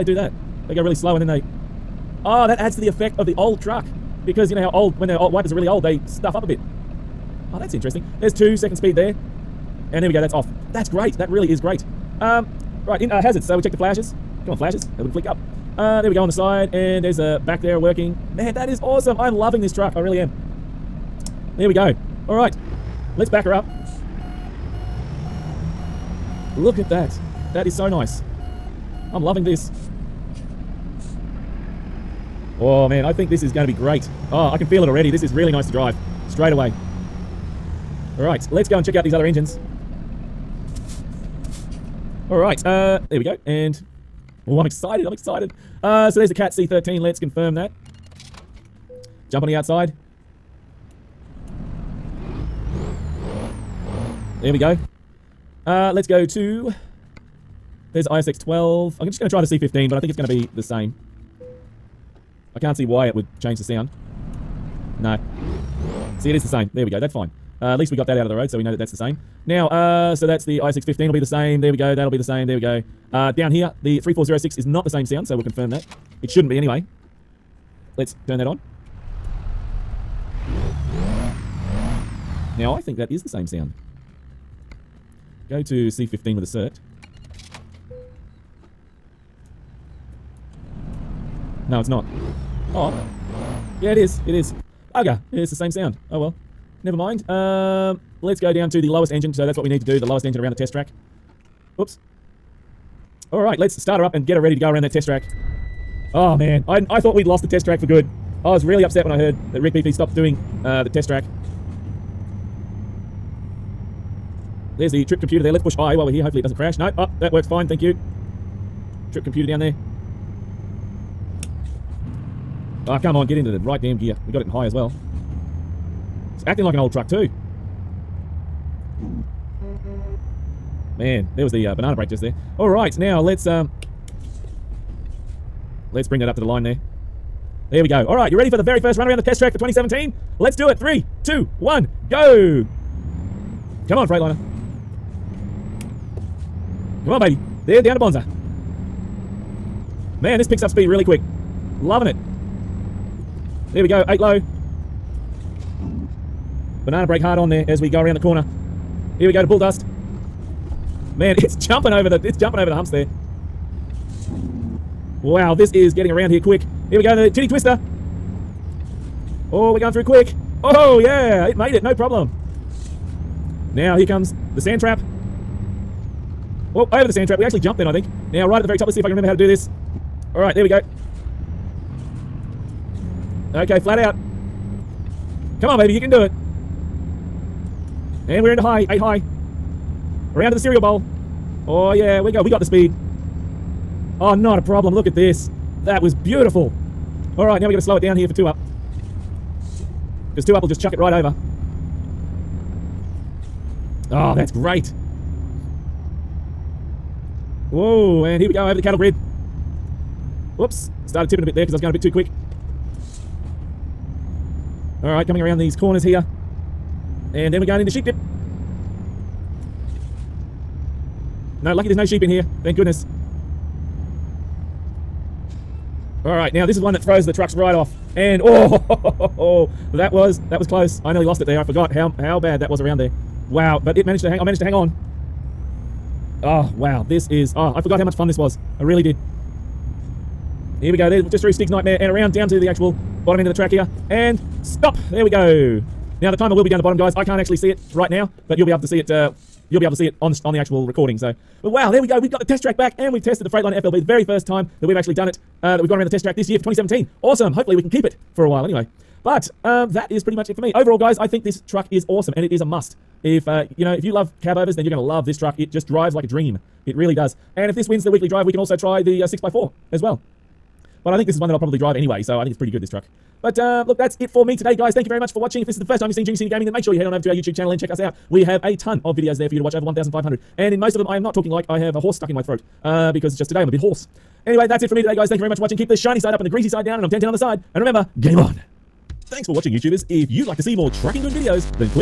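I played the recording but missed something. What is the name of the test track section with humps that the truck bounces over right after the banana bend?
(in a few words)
Bull dust.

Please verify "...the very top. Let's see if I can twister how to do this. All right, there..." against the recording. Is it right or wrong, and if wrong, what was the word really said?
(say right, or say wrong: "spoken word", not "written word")
wrong: "remember", not "twister".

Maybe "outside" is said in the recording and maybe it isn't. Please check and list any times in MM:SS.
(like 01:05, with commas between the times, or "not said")
00:49.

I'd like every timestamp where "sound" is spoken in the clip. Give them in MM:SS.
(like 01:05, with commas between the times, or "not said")
01:03, 01:15, 01:23, 01:35.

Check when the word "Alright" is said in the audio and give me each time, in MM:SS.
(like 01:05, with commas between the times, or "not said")
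00:38, 00:42, 01:43, 03:35, 03:46.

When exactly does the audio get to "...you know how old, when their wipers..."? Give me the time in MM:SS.
00:04.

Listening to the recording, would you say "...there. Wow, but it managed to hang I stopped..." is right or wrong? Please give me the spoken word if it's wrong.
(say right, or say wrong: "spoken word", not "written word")
wrong: "managed", not "stopped".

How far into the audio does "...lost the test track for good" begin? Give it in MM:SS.
01:47.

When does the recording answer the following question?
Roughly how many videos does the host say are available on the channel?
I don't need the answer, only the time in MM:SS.
04:39.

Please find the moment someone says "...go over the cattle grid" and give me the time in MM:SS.
03:28.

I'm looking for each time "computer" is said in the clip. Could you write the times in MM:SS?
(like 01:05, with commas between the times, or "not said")
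01:55, 01:59.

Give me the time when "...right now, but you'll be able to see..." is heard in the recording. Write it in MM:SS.
04:07.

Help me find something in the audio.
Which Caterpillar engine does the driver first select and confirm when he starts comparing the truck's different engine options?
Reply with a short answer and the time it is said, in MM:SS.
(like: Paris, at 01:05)
Cat C13, at 00:46.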